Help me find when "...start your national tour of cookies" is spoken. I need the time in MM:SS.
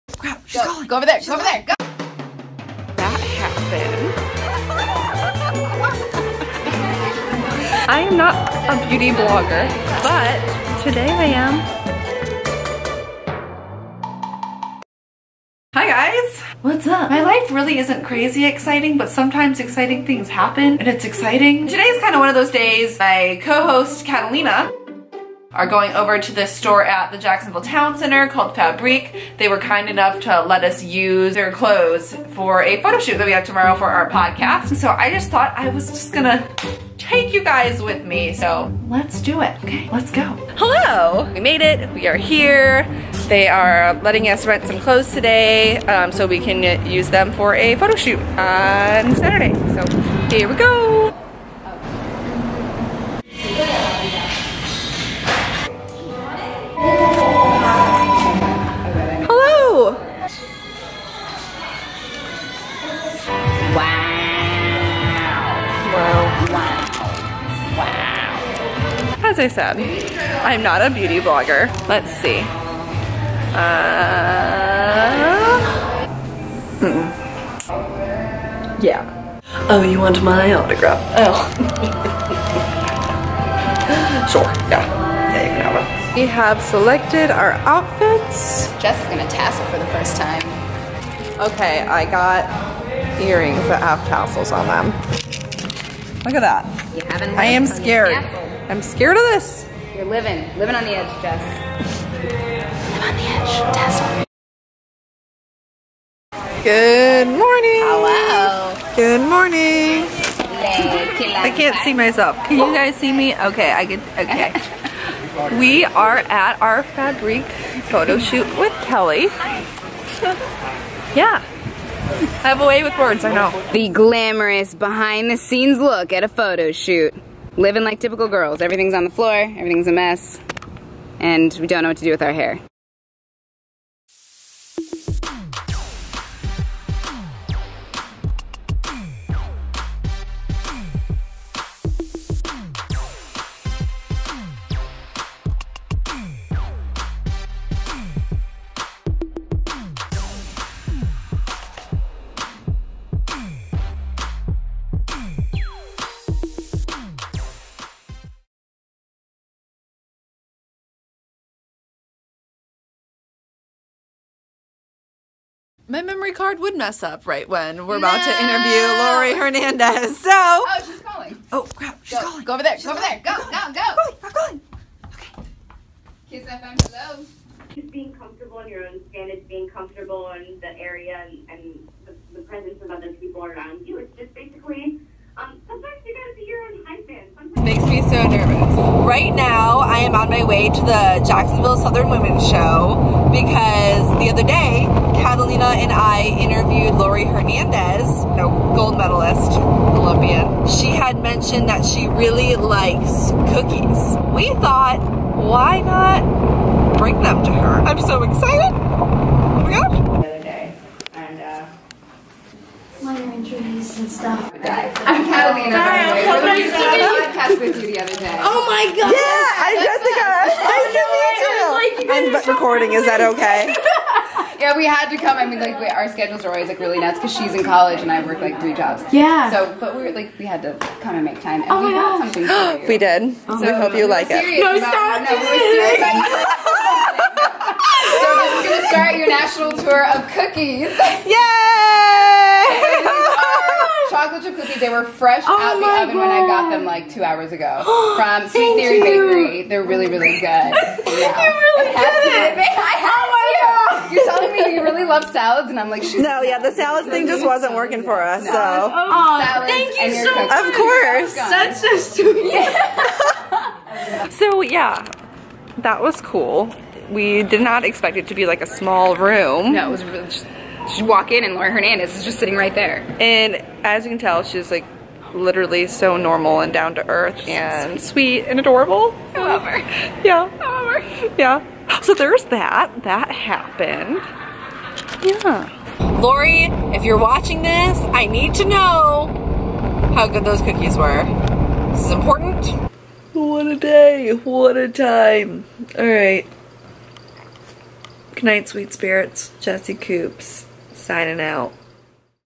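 03:58.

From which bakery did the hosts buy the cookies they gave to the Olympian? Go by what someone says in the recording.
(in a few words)
Sweet Theory.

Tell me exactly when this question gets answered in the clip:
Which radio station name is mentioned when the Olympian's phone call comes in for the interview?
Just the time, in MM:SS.
02:56.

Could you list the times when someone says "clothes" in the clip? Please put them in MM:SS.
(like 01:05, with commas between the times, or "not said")
00:31, 00:44.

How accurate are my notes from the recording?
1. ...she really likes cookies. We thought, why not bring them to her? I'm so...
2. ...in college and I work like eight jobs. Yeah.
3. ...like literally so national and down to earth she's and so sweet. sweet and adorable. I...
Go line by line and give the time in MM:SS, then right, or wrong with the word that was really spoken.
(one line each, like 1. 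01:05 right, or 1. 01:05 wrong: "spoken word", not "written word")
1. 03:21 right
2. 03:47 wrong: "three", not "eight"
3. 04:34 wrong: "normal", not "national".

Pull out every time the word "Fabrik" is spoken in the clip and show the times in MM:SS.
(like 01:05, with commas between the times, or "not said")
00:28, 01:56.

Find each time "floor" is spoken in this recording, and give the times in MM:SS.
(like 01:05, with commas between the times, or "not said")
02:09.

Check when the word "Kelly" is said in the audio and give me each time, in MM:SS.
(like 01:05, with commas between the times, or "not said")
01:58.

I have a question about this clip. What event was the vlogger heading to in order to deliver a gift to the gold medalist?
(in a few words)
Jacksonville Southern Women's Show.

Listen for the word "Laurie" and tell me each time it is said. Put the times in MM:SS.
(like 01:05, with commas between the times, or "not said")
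02:49, 03:16, 04:31, 04:46.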